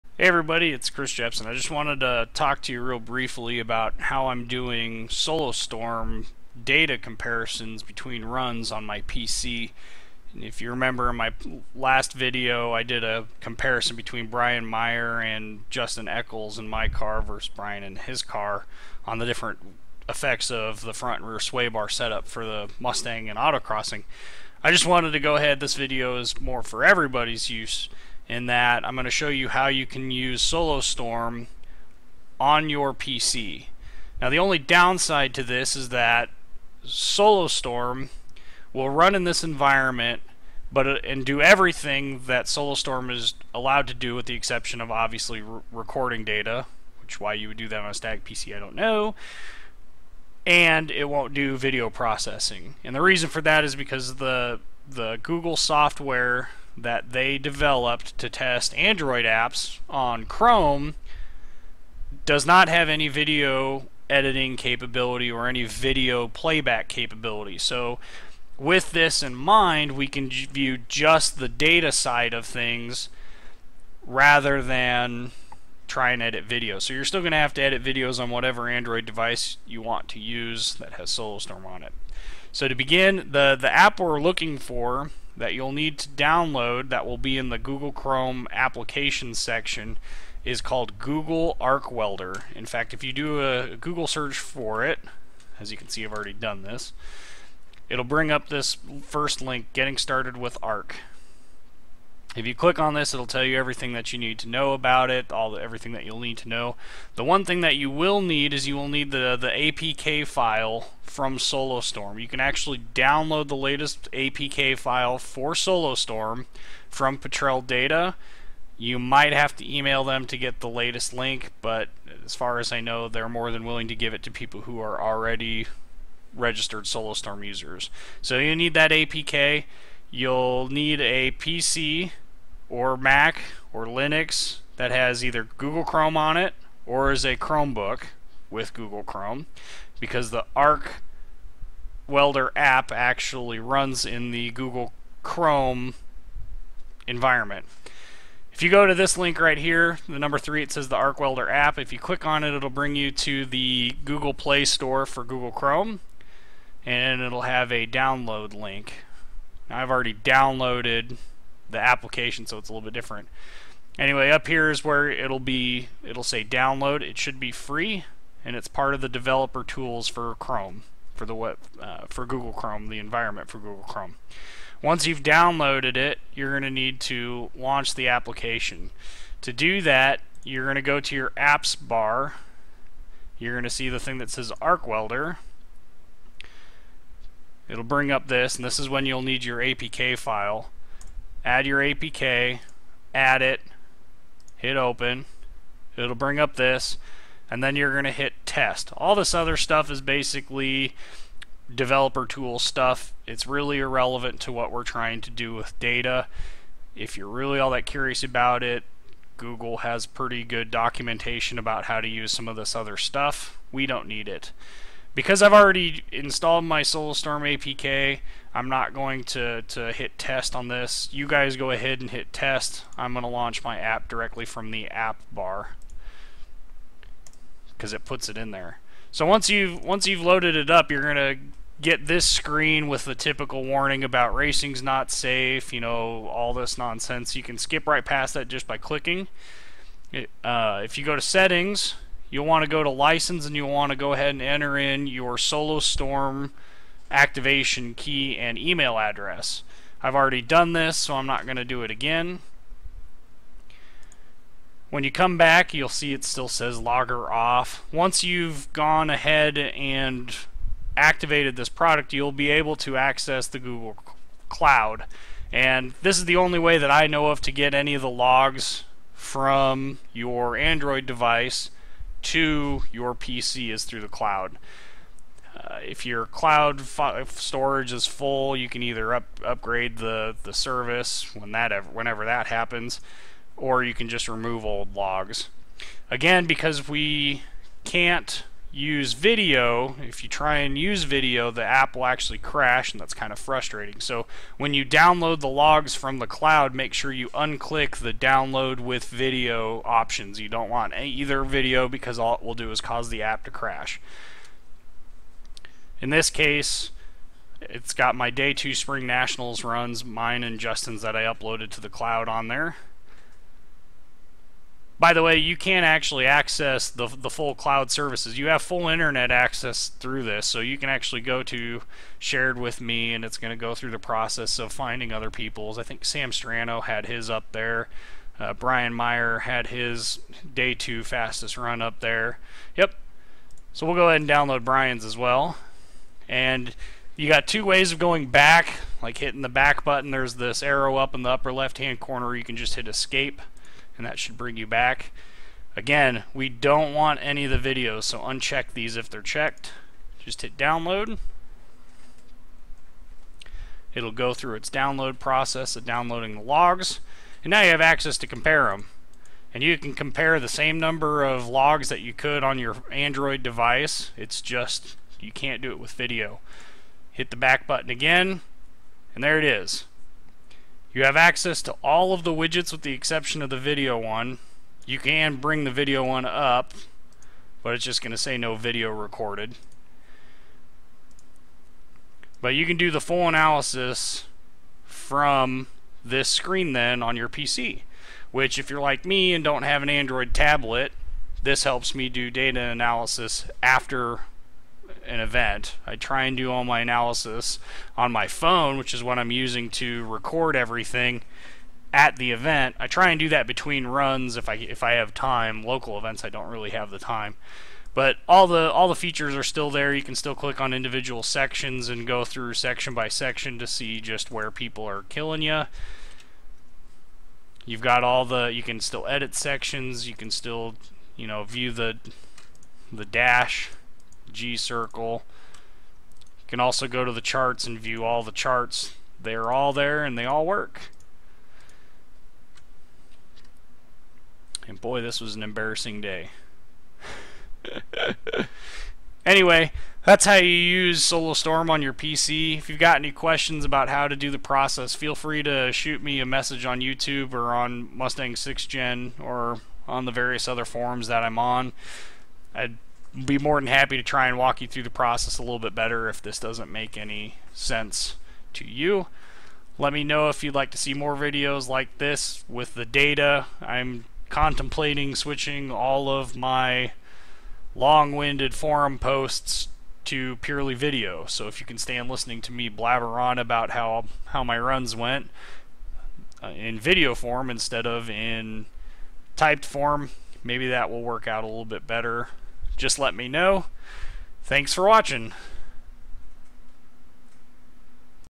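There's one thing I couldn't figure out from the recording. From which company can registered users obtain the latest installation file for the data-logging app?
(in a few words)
Petrel Data.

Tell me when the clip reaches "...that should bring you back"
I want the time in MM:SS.
05:44.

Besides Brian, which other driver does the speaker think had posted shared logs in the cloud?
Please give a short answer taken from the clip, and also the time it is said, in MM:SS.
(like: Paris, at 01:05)
Sam Strano, at 05:26.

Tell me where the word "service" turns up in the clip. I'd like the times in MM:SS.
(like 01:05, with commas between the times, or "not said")
04:40, 05:17.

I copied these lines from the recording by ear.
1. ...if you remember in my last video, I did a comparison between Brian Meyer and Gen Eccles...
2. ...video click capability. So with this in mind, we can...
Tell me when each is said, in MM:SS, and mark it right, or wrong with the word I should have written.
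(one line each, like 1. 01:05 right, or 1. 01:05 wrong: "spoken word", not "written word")
1. 00:10 wrong: "Justin", not "Gen"
2. 01:05 wrong: "playback", not "click".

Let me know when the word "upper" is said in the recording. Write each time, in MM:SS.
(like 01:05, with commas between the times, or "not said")
05:41.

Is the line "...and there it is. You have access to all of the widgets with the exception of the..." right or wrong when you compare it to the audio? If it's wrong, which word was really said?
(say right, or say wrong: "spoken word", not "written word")
right.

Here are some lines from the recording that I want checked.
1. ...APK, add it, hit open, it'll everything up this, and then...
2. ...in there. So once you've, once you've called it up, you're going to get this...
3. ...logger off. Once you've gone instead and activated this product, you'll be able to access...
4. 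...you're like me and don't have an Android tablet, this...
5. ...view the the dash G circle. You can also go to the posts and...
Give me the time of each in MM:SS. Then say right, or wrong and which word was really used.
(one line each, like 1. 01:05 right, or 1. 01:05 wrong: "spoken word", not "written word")
1. 03:11 wrong: "bring", not "everything"
2. 03:48 wrong: "loaded", not "called"
3. 04:16 wrong: "ahead", not "instead"
4. 06:28 right
5. 07:01 wrong: "charts", not "posts".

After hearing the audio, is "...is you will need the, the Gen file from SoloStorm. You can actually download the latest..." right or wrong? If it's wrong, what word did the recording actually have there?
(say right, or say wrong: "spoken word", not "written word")
wrong: "APK", not "Gen".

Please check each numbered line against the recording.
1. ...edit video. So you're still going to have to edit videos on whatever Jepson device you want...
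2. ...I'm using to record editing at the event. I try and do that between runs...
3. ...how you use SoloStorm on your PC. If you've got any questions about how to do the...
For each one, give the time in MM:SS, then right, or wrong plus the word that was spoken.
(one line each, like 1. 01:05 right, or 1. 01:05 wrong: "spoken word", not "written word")
1. 01:16 wrong: "Android", not "Jepson"
2. 06:39 wrong: "everything", not "editing"
3. 07:20 right.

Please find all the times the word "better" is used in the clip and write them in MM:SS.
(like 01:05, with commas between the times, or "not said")
07:35, 08:01.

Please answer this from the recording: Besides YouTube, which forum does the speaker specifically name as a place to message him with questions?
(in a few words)
Mustang 6 Gen.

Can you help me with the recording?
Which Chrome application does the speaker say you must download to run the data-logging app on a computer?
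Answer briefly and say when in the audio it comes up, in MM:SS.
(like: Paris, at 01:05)
Google Arc Welder, at 01:30.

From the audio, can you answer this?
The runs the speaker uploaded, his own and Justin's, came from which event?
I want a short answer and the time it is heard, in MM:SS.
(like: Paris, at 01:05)
spring nationals, at 05:08.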